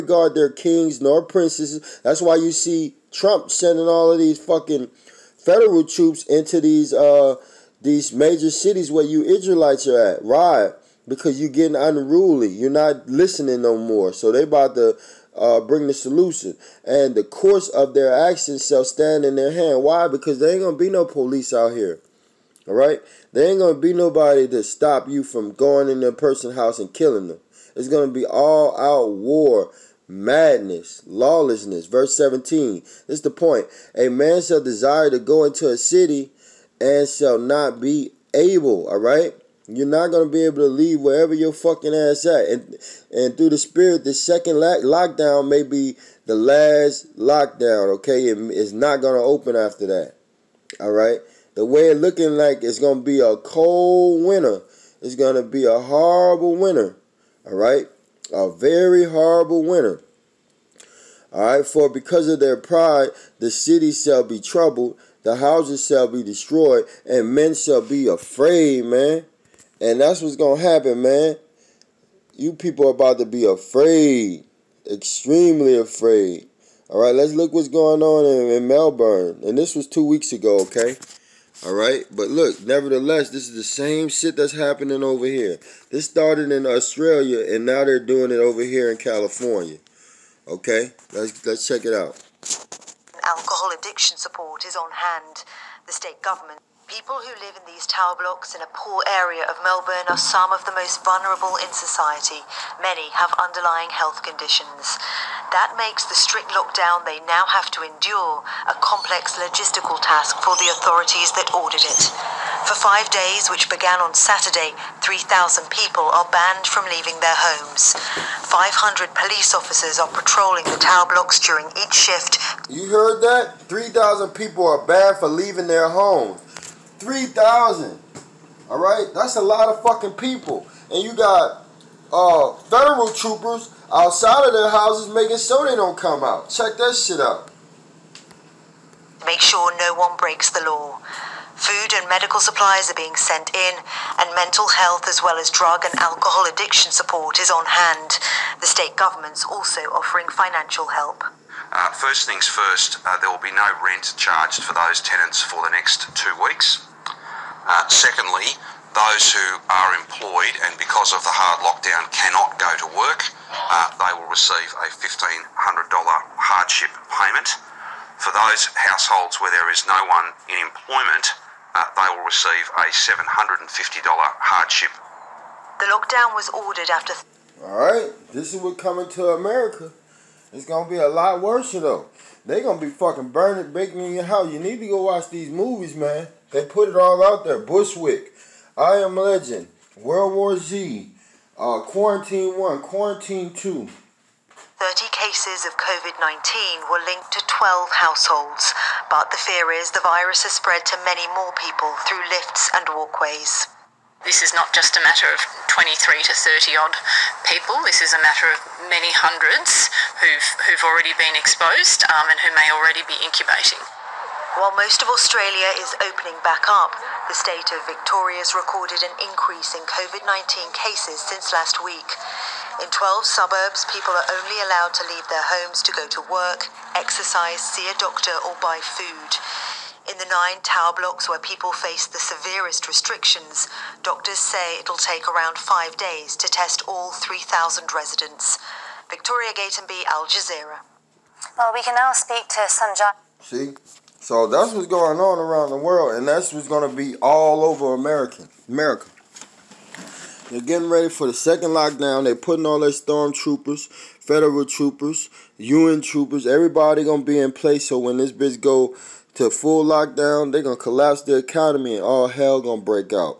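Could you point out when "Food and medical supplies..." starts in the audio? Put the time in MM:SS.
02:21.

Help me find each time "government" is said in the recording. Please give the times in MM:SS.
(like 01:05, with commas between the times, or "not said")
01:36, 02:28.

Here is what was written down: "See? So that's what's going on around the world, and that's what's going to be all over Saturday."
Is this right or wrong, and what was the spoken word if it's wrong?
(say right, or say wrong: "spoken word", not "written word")
wrong: "America", not "Saturday".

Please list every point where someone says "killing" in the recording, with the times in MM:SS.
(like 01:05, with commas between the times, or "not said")
00:26.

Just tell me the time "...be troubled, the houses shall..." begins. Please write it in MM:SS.
01:04.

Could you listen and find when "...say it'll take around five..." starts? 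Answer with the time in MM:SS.
03:54.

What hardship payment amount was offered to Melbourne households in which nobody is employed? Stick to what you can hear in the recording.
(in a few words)
$750.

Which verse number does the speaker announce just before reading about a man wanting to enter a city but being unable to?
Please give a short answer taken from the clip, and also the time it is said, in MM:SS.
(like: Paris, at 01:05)
17, at 00:31.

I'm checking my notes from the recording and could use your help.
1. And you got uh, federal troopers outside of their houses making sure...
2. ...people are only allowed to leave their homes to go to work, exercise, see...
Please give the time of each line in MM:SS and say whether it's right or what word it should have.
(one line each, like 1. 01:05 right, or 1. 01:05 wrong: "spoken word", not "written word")
1. 02:10 right
2. 03:43 right.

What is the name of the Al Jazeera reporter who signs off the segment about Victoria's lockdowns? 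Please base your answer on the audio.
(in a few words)
Victoria Gatenby.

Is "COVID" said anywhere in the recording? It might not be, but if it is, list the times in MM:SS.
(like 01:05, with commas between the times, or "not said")
03:15, 03:39.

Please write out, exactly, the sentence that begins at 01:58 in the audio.
500 police officers are patrolling the tower blocks during each shift.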